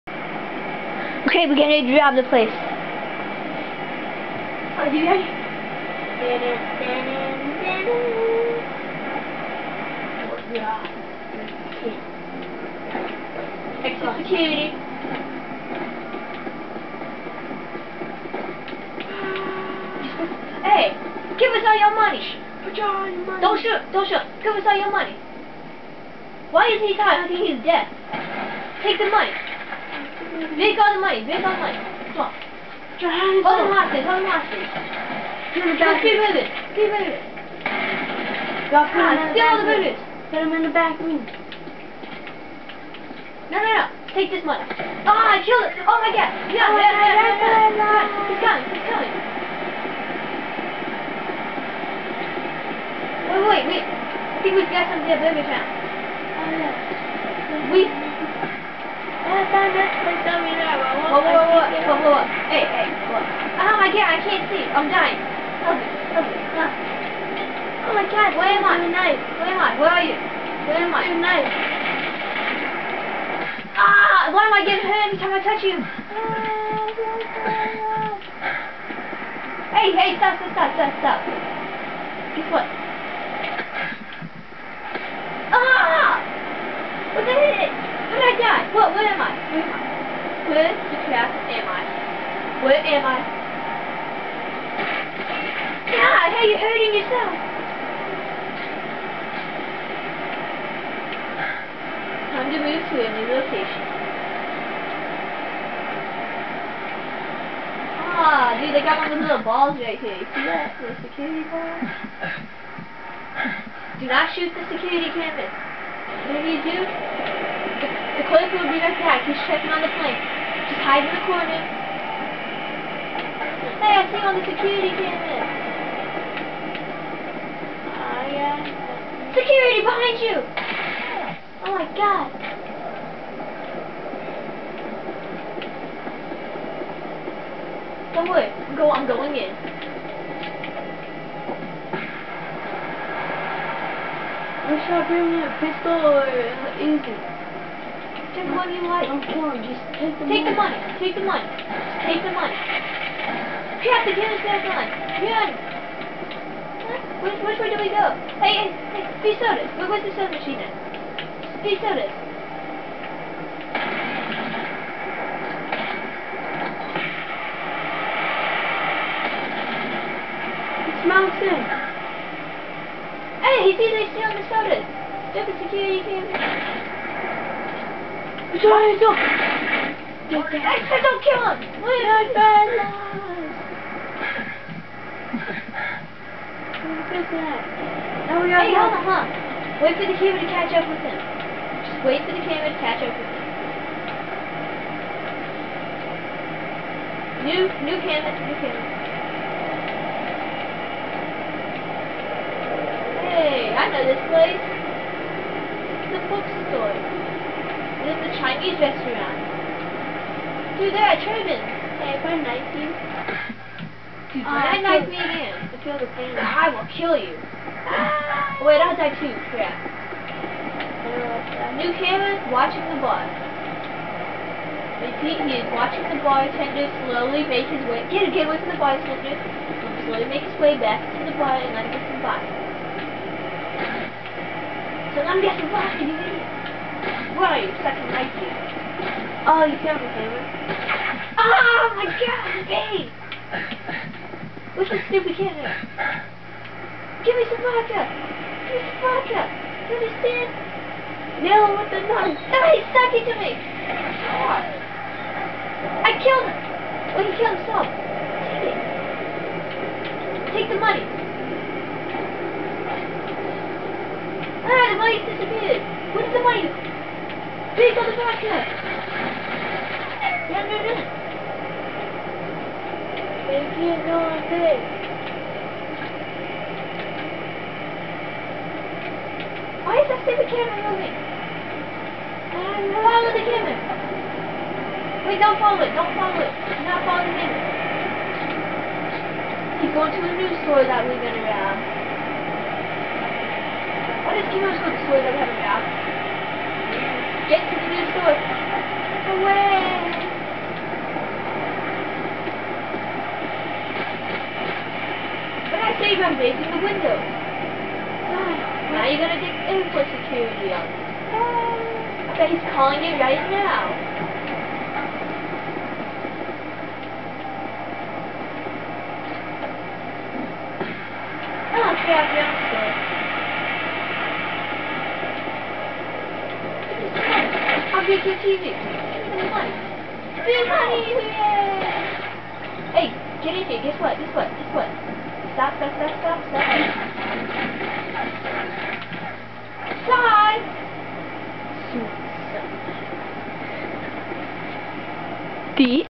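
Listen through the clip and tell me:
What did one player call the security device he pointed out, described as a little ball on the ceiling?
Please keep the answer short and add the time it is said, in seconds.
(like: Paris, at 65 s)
security ball, at 111 s.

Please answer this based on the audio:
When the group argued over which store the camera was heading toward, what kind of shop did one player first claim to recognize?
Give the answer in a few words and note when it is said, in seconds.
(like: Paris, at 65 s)
bookstore, at 206 s.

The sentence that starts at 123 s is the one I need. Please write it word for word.
Hey, I see on the security camera.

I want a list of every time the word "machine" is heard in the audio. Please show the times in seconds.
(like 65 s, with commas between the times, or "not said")
160 s.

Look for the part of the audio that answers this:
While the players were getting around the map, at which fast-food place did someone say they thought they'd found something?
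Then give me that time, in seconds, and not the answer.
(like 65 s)
55 s.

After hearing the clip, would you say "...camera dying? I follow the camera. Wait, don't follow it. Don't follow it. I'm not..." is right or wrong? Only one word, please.
wrong.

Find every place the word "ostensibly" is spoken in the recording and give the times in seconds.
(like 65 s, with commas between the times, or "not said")
not said.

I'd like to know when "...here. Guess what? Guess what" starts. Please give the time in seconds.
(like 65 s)
333 s.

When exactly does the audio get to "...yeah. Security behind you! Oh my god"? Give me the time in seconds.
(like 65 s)
128 s.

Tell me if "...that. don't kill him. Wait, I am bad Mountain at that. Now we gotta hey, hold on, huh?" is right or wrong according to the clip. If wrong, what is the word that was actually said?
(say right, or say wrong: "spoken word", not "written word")
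wrong: "Look", not "Mountain".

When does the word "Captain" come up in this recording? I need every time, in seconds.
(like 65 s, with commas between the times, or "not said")
153 s.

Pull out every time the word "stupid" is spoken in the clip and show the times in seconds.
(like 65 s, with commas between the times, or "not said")
175 s, 245 s, 280 s.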